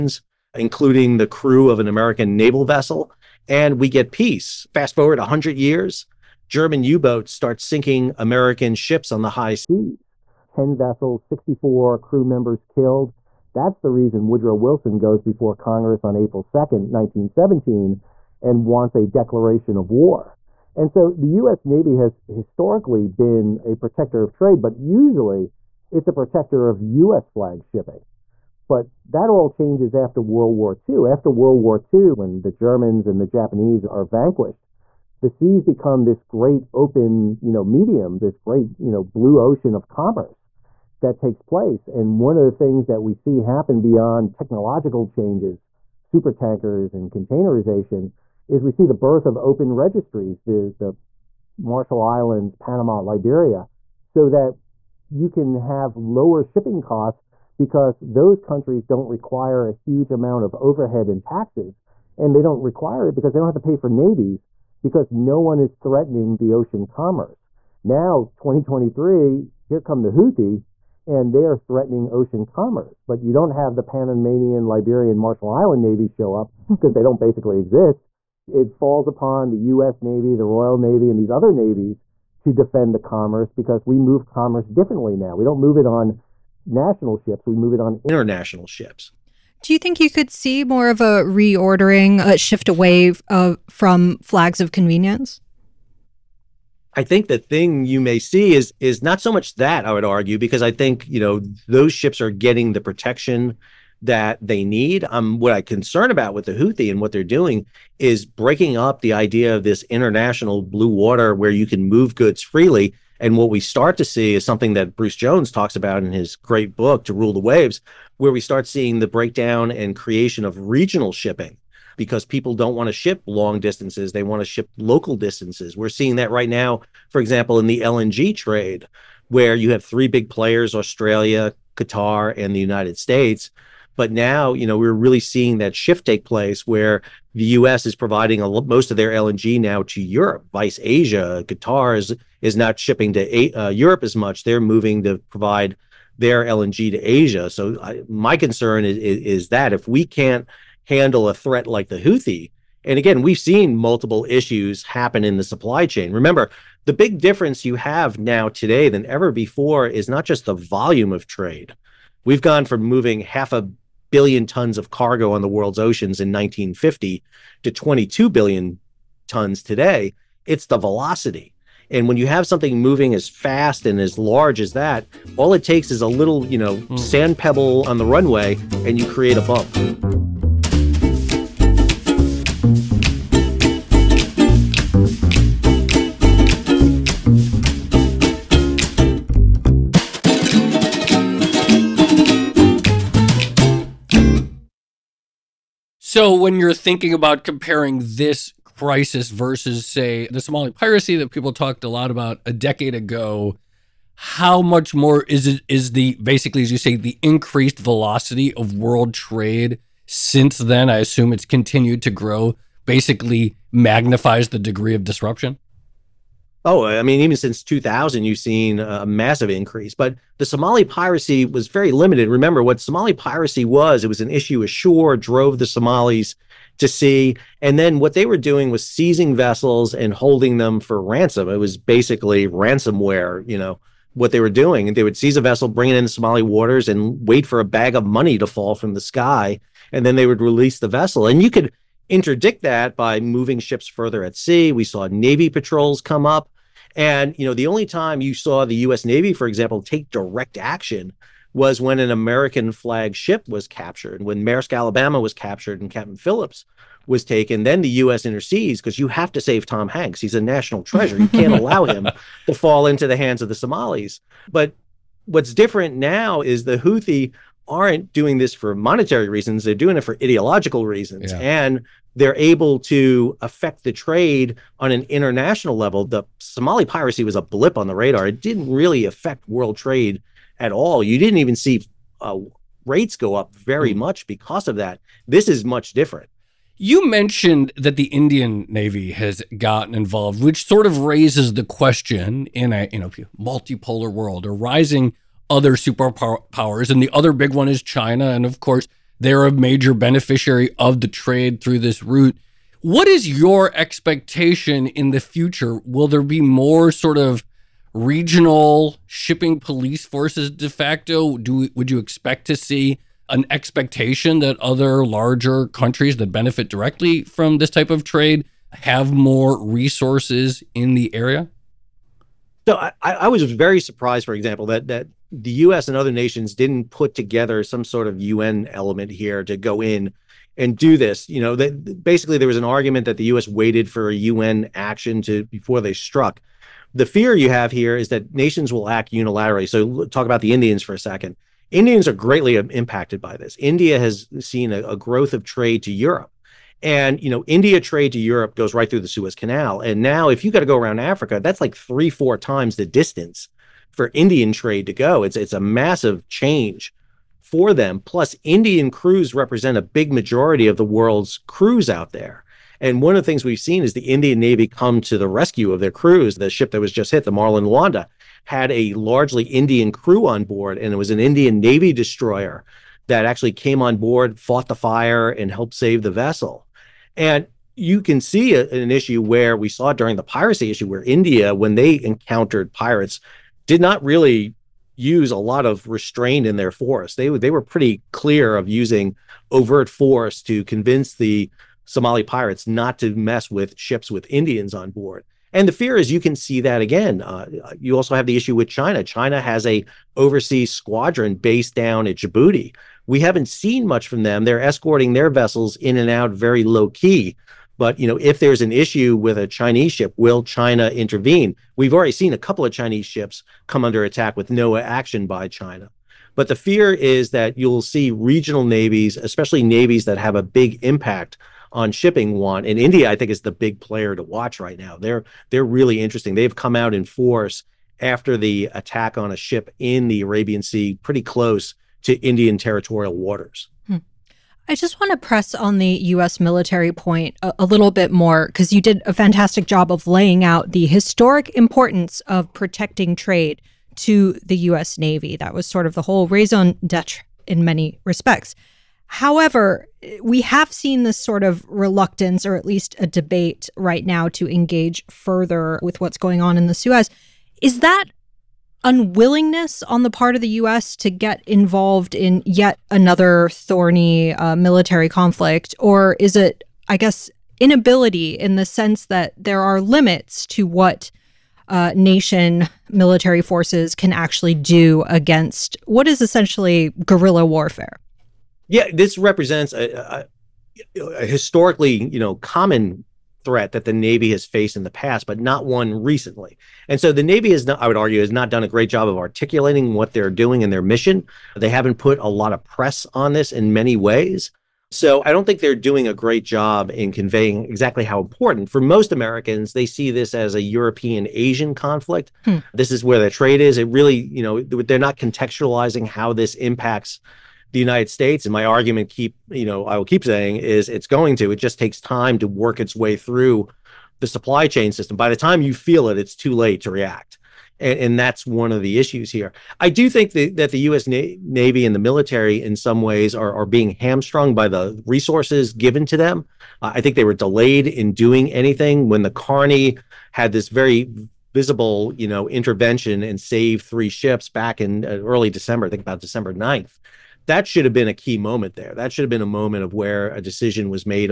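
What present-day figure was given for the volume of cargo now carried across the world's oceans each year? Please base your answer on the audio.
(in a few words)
22 billion tons.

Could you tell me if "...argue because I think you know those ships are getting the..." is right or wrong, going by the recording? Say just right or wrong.
right.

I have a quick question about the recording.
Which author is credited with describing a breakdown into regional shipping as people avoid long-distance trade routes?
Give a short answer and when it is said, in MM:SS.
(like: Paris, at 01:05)
Bruce Jones, at 01:54.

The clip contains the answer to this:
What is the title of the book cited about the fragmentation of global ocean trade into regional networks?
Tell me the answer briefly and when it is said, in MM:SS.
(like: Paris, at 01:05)
To Rule the Waves, at 01:57.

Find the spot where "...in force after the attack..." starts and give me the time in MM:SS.
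07:06.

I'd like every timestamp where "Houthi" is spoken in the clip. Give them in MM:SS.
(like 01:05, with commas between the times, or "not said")
01:10, 01:46, 02:31, 04:26.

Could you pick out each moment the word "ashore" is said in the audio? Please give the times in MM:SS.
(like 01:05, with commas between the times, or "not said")
03:44.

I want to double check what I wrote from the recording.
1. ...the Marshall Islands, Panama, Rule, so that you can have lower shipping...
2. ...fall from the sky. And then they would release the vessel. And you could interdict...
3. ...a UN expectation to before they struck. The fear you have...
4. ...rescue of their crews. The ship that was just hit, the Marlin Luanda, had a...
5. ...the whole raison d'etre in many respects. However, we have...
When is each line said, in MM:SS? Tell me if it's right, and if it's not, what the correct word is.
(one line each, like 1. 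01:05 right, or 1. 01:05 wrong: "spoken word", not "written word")
1. 00:50 wrong: "Liberia", not "Rule"
2. 03:58 right
3. 05:34 wrong: "action", not "expectation"
4. 06:05 right
5. 07:25 right.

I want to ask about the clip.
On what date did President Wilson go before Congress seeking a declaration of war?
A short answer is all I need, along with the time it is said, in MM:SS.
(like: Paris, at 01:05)
April 2nd, 1917, at 00:16.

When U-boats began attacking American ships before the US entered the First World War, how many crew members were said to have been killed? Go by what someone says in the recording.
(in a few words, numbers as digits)
64.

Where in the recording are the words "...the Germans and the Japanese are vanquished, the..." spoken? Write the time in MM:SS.
00:32.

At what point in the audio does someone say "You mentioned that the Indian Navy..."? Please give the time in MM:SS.
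04:46.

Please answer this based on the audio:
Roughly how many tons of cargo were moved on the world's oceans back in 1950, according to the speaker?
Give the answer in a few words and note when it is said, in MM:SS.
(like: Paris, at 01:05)
Half a billion tons, at 02:43.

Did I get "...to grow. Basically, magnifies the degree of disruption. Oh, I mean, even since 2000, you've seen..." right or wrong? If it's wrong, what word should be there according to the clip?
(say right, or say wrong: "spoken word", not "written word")
right.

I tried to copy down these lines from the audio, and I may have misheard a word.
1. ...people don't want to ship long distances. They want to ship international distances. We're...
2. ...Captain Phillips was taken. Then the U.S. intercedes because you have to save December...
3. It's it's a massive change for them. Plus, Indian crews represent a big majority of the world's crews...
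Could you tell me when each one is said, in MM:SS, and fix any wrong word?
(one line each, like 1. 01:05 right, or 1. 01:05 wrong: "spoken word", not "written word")
1. 02:02 wrong: "local", not "international"
2. 04:15 wrong: "Tom", not "December"
3. 05:55 right.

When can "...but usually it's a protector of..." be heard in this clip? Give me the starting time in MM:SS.
00:24.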